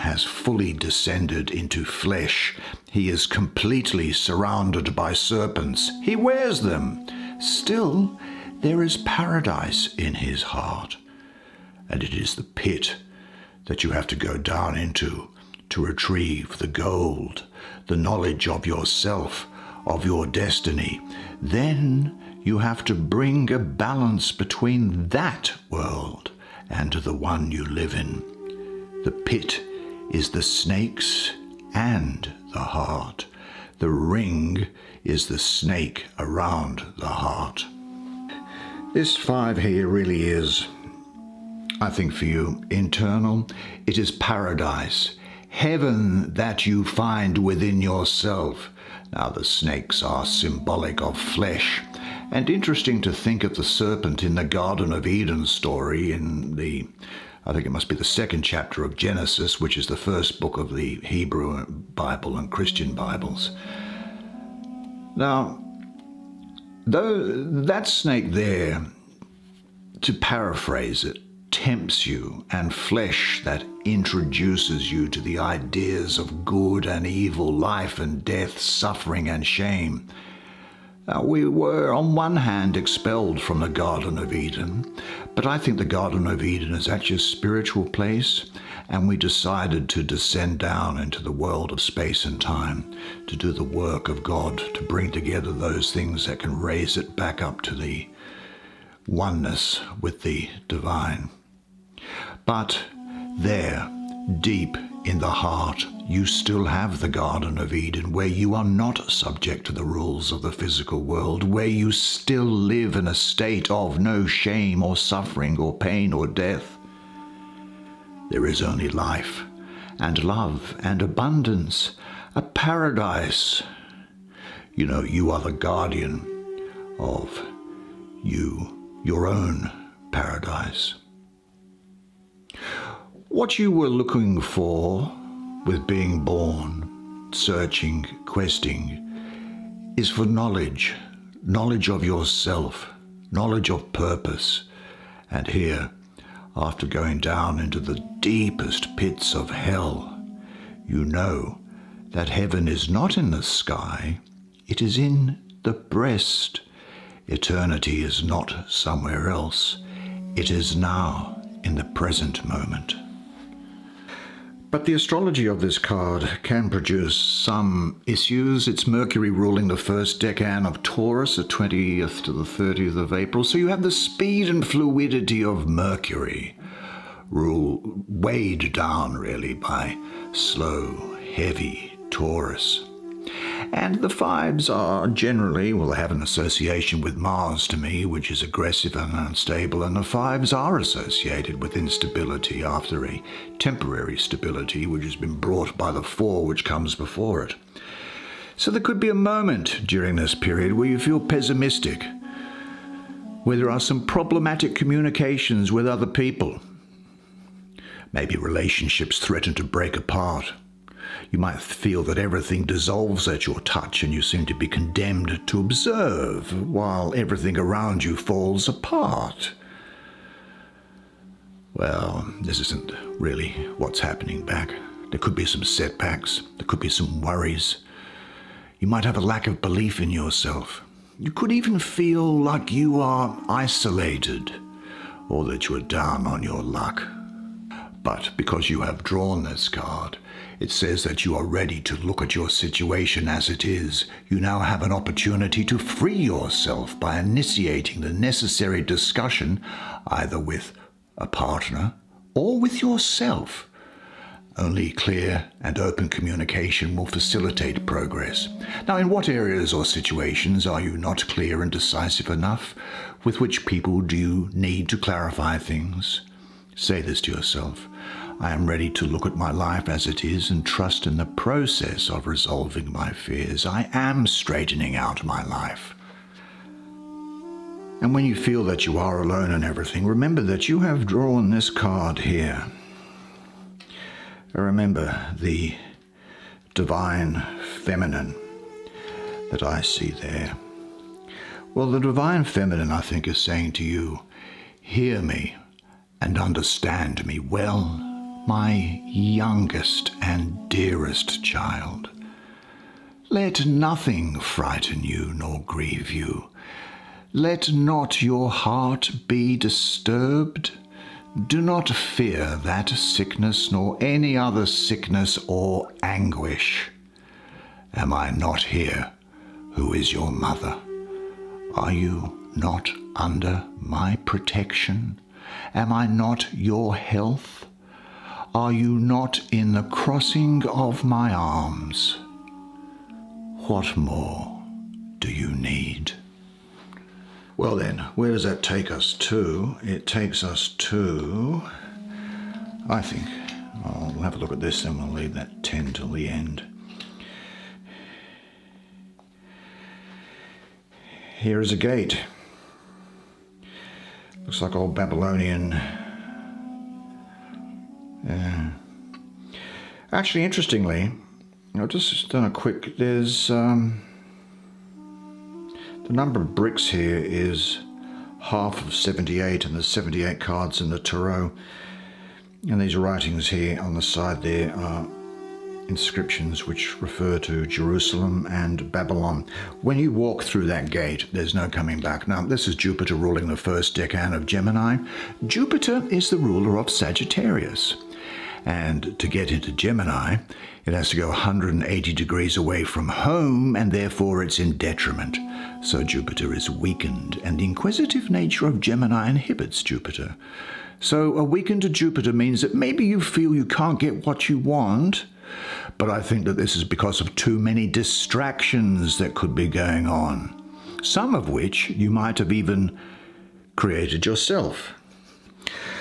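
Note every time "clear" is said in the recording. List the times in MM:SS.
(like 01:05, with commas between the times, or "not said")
04:14, 04:21.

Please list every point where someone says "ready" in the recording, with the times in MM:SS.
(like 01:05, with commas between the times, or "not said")
04:01, 04:28.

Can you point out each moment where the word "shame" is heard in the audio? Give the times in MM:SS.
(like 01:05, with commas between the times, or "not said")
01:19, 01:54.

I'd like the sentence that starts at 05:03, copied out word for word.
Let nothing frighten you nor grieve you.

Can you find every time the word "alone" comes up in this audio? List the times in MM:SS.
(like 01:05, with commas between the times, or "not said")
04:39.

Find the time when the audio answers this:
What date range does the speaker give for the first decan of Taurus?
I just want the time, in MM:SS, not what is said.
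02:51.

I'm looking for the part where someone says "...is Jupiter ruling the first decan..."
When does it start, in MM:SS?
06:22.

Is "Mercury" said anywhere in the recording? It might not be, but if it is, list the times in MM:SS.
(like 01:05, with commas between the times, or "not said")
02:48, 02:55.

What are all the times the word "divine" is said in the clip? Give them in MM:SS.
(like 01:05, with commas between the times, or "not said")
01:40, 04:46, 04:52.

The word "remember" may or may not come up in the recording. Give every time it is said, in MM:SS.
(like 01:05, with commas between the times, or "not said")
04:40, 04:44.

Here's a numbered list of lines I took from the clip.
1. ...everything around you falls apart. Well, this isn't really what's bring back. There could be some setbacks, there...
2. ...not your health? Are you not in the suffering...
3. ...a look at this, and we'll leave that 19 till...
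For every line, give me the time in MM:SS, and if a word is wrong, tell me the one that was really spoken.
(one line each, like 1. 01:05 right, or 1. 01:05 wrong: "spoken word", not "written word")
1. 03:37 wrong: "happening", not "bring"
2. 05:26 wrong: "crossing", not "suffering"
3. 05:44 wrong: "10", not "19".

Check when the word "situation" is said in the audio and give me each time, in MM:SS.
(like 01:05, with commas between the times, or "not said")
04:02, 04:19.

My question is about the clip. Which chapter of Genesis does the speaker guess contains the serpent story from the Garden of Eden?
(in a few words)
Second chapter.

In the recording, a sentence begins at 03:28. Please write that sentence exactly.
Maybe relationships threaten to break apart.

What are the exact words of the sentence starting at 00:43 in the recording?
It is paradise heaven that you find within yourself.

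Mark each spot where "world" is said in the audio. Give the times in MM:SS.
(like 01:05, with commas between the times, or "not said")
00:25, 01:31, 01:51.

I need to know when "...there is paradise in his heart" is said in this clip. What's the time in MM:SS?
00:08.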